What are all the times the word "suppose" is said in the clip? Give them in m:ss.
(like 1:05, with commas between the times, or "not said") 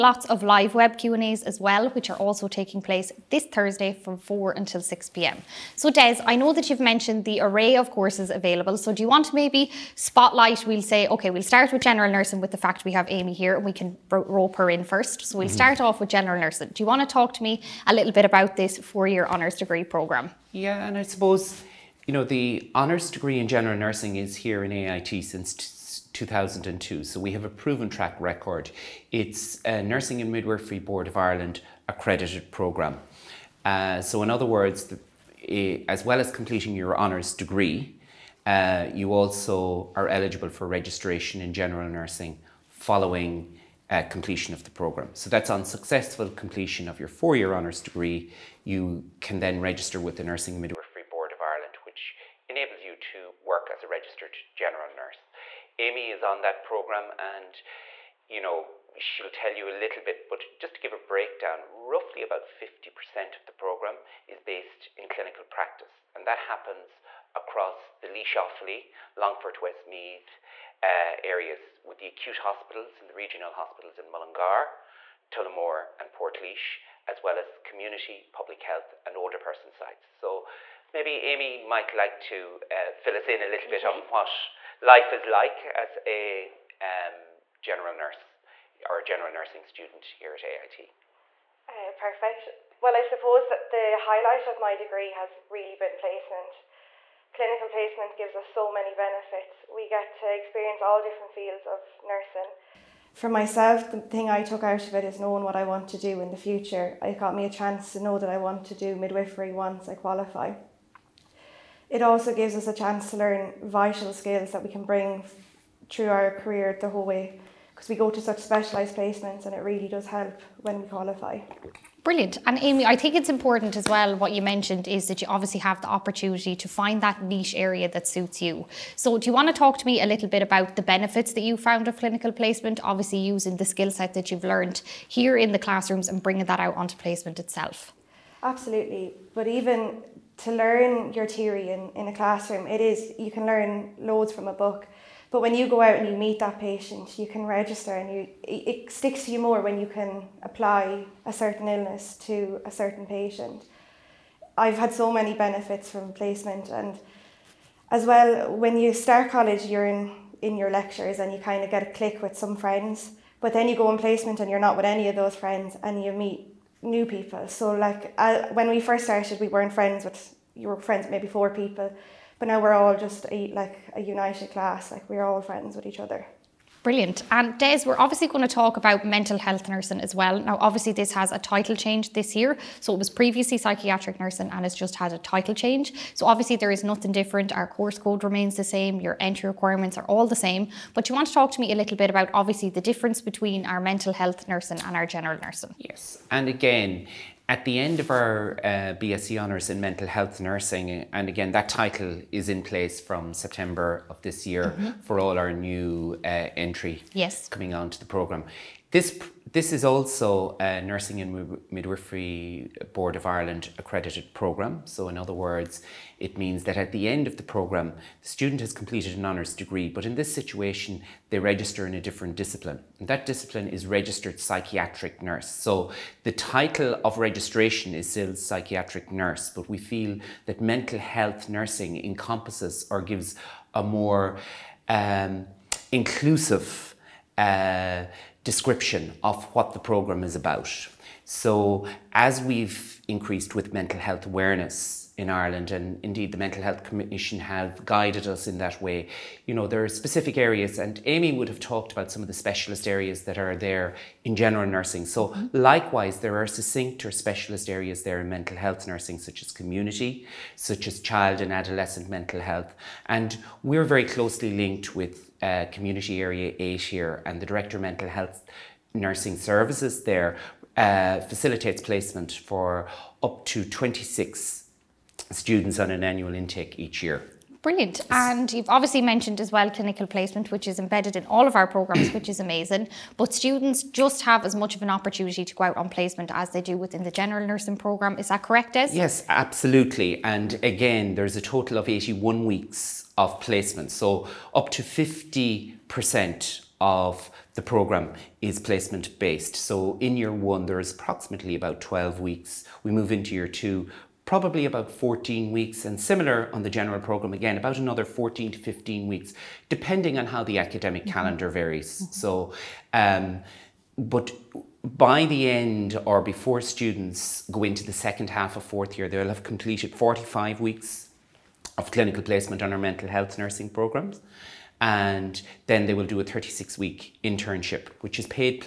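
0:21, 1:33.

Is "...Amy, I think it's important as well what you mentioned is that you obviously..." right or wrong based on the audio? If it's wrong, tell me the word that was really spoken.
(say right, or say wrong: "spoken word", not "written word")
right.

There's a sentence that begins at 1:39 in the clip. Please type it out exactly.
We get to experience all different fields of nursing.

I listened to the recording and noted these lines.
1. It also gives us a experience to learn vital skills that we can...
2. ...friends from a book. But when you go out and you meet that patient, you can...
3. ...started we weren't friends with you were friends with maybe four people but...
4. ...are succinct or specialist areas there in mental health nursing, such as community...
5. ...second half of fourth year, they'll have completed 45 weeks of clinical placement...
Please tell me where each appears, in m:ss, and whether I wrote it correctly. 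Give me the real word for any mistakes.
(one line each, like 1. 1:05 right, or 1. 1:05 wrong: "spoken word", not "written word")
1. 1:51 wrong: "chance", not "experience"
2. 2:23 wrong: "loads", not "friends"
3. 2:49 right
4. 4:16 right
5. 5:17 right.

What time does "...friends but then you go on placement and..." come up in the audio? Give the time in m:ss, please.
2:42.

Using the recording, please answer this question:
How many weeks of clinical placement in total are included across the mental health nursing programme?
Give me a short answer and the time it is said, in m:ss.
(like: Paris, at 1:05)
81, at 4:51.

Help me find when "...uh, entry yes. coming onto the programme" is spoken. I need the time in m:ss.
3:26.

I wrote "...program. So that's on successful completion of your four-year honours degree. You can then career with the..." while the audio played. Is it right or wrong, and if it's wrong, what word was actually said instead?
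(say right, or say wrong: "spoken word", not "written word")
wrong: "register", not "career".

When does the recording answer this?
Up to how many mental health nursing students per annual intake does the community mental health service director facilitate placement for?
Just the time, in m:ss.
4:33.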